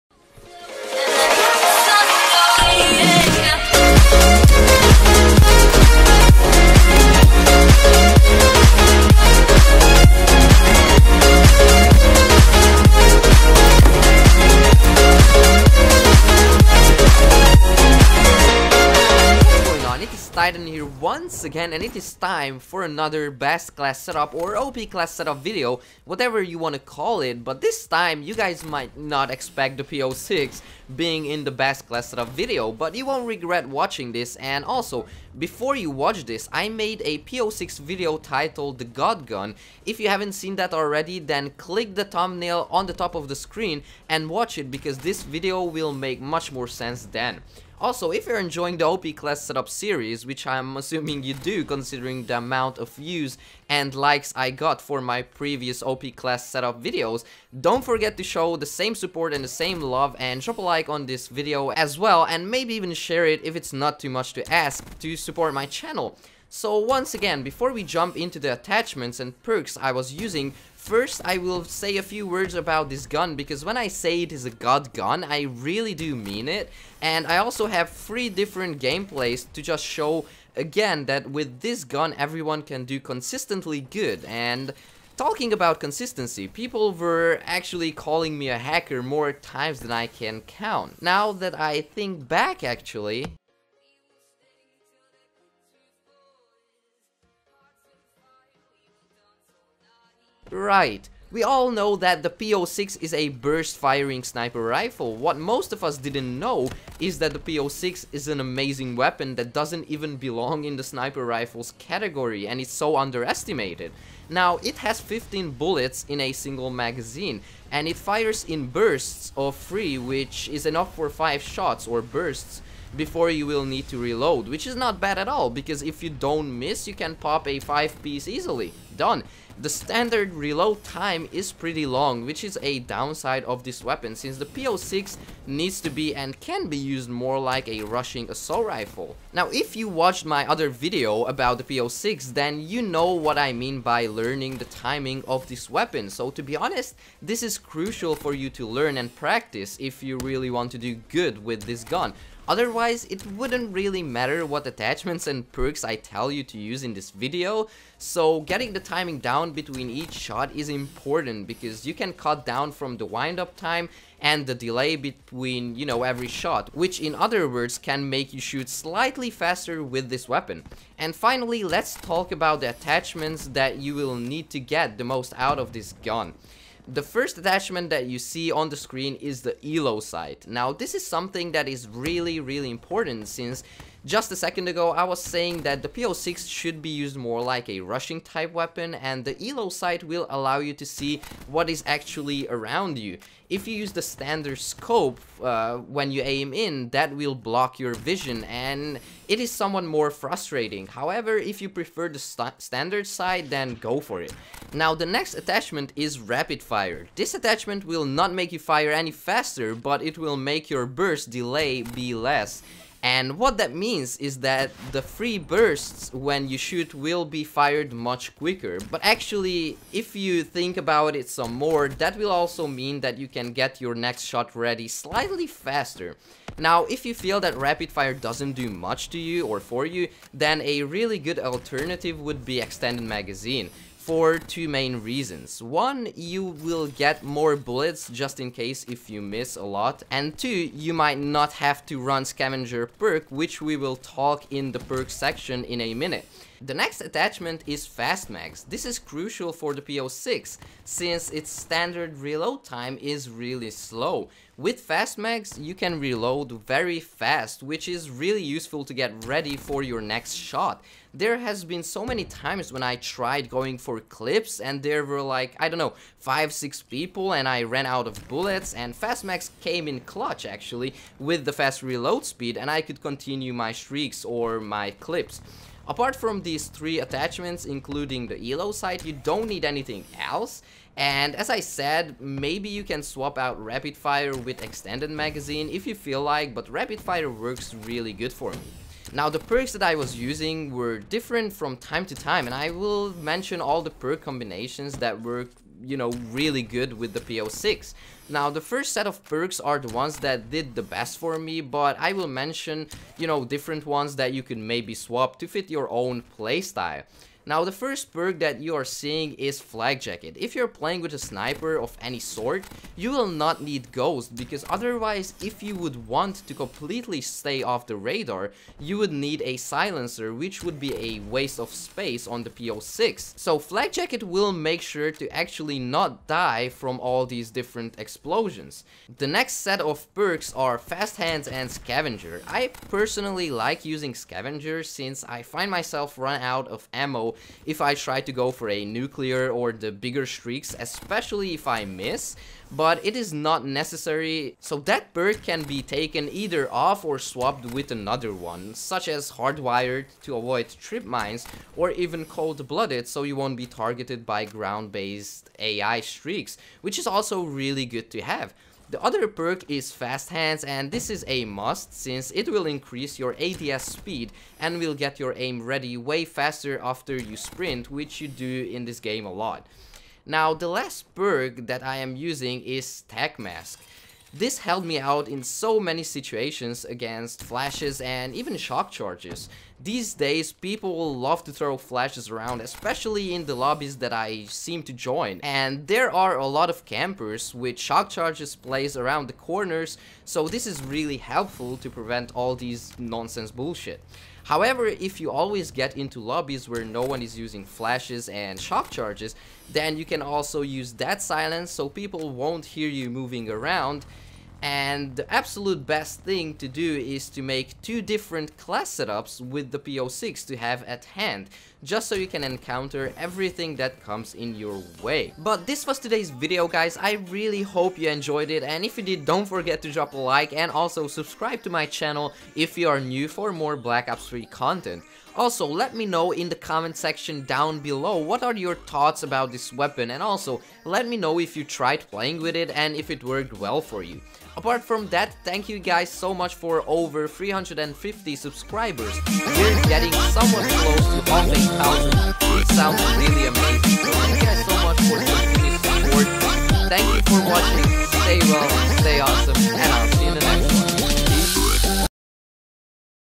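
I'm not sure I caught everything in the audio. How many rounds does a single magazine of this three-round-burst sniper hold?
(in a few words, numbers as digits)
15.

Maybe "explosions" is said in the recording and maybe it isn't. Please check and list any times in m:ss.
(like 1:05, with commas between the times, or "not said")
5:27.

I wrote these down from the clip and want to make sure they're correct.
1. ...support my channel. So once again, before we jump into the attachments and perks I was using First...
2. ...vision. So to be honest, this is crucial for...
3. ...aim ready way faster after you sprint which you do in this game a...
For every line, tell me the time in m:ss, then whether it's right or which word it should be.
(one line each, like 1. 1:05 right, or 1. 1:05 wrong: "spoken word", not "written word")
1. 1:05 right
2. 2:25 wrong: "weapon", not "vision"
3. 6:05 right.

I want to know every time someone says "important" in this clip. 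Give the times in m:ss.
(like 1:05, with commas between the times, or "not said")
2:40, 3:02.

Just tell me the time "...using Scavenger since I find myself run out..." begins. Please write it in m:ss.
5:33.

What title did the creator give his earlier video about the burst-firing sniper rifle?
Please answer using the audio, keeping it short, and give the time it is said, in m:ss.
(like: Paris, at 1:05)
The God Gun, at 0:38.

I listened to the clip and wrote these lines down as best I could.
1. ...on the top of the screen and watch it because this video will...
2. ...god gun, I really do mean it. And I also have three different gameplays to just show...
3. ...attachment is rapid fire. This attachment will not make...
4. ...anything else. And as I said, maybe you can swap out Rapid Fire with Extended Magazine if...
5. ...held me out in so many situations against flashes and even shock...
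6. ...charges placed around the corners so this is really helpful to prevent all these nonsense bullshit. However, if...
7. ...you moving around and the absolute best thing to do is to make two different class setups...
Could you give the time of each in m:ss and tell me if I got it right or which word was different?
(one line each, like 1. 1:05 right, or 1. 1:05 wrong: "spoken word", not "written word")
1. 0:42 right
2. 1:14 right
3. 3:25 right
4. 4:39 right
5. 6:14 right
6. 6:28 right
7. 6:42 right.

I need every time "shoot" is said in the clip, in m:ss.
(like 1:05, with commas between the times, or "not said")
2:48, 3:36.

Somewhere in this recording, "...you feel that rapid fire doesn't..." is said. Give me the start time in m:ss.
3:47.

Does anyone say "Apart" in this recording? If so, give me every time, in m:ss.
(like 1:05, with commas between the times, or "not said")
4:35, 7:14.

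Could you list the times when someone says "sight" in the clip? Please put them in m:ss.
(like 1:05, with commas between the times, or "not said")
2:59, 3:09, 3:23, 4:38.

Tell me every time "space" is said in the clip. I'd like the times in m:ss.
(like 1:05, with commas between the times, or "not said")
5:21.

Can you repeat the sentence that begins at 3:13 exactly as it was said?
If you use the standard scope uh, when you aim in, that will block your vision and it is somewhat more frustrating.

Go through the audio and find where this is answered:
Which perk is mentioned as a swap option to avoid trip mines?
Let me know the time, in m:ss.
5:49.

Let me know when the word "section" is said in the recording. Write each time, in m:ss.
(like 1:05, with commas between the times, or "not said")
4:05, 7:06.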